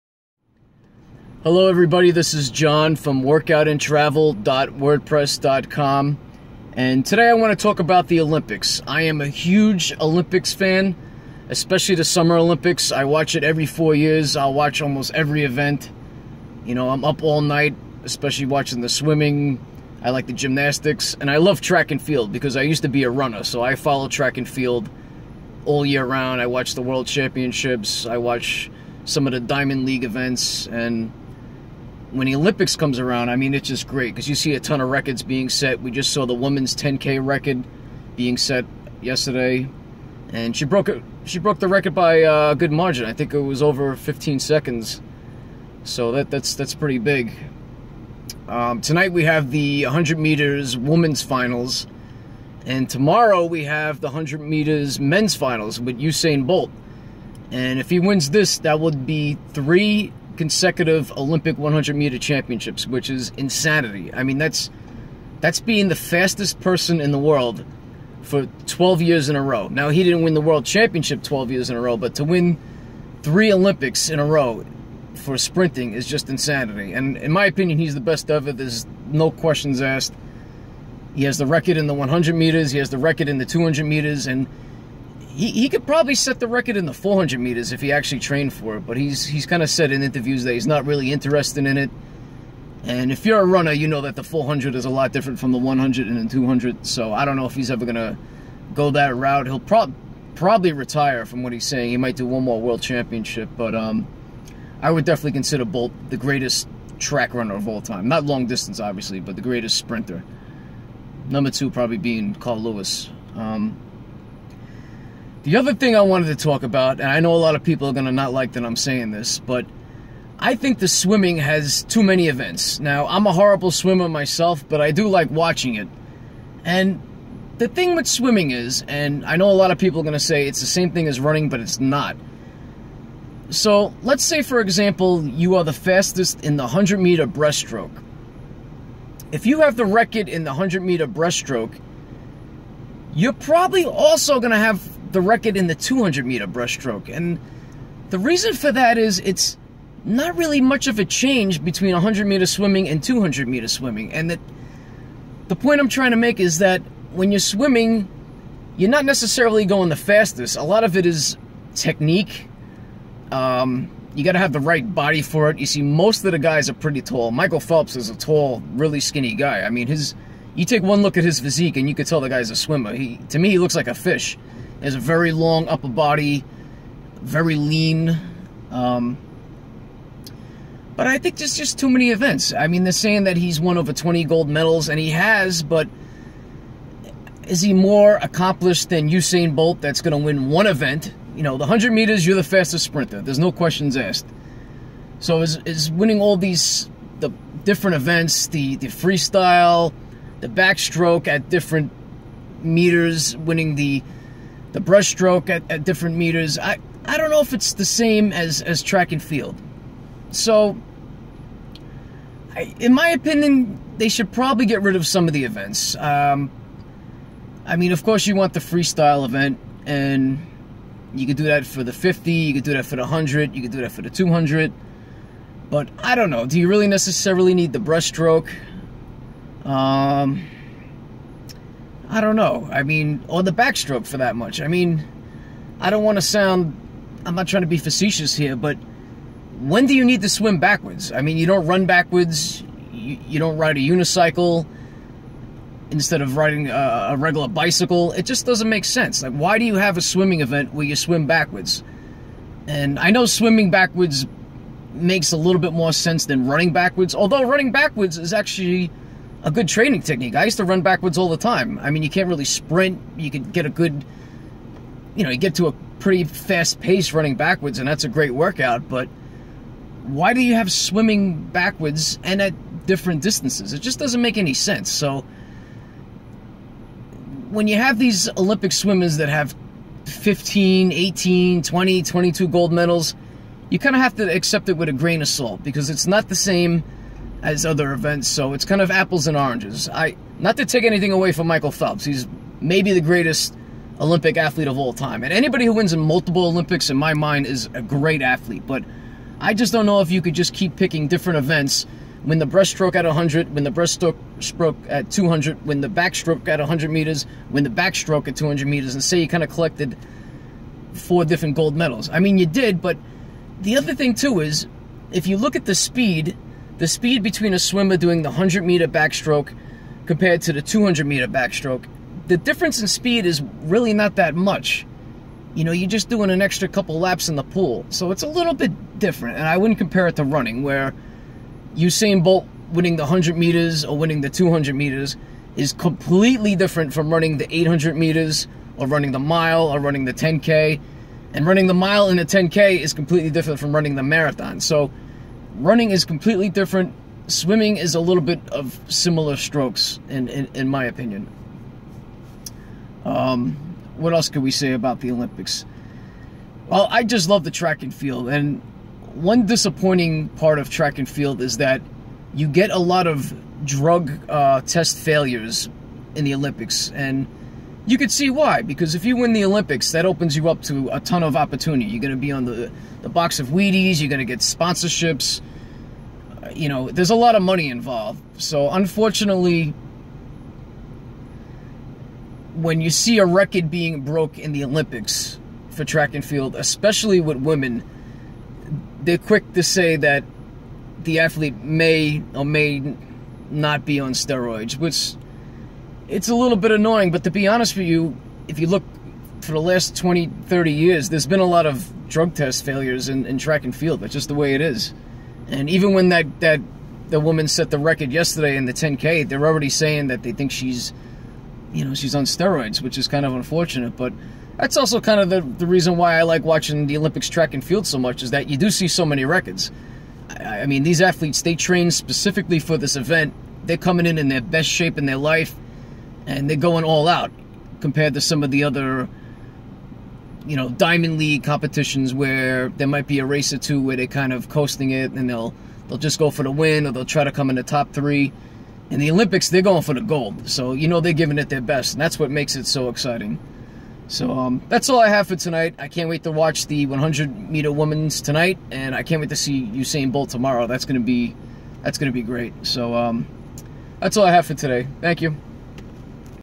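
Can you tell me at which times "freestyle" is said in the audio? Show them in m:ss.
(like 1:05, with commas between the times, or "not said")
3:18, 3:38.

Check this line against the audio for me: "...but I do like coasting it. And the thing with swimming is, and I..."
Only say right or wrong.
wrong.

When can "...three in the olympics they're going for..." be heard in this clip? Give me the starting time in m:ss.
7:17.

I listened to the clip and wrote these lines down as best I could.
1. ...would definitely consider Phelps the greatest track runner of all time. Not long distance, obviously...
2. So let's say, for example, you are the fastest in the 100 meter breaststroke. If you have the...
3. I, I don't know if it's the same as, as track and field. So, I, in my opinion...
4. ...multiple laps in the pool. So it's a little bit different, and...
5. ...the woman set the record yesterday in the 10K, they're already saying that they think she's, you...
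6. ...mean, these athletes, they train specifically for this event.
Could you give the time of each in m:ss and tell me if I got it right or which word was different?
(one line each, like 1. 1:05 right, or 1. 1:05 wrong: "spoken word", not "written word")
1. 1:44 wrong: "Bolt", not "Phelps"
2. 2:13 right
3. 3:26 right
4. 5:26 wrong: "couple", not "multiple"
5. 6:47 right
6. 7:00 right.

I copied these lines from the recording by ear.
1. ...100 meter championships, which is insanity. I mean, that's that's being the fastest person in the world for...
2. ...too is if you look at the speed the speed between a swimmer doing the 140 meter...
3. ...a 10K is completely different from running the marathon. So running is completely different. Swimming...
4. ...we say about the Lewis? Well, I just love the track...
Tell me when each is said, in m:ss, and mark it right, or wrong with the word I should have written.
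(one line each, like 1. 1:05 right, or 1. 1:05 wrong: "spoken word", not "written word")
1. 1:01 right
2. 5:14 wrong: "100", not "140"
3. 5:42 right
4. 5:54 wrong: "Olympics", not "Lewis".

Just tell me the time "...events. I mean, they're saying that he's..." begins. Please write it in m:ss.
3:02.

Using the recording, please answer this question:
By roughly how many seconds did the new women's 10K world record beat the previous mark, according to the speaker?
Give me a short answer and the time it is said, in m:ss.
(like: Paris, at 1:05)
over 15 seconds, at 0:43.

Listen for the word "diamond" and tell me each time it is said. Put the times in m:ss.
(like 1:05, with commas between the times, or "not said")
0:29, 7:10.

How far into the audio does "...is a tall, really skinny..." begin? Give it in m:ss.
2:47.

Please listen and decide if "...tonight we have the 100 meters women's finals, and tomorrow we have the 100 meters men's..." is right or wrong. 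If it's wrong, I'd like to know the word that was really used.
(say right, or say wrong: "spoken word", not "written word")
right.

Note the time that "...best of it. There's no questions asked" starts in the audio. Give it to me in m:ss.
1:18.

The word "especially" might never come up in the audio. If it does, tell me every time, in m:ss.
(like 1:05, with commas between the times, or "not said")
0:11, 0:18, 6:26.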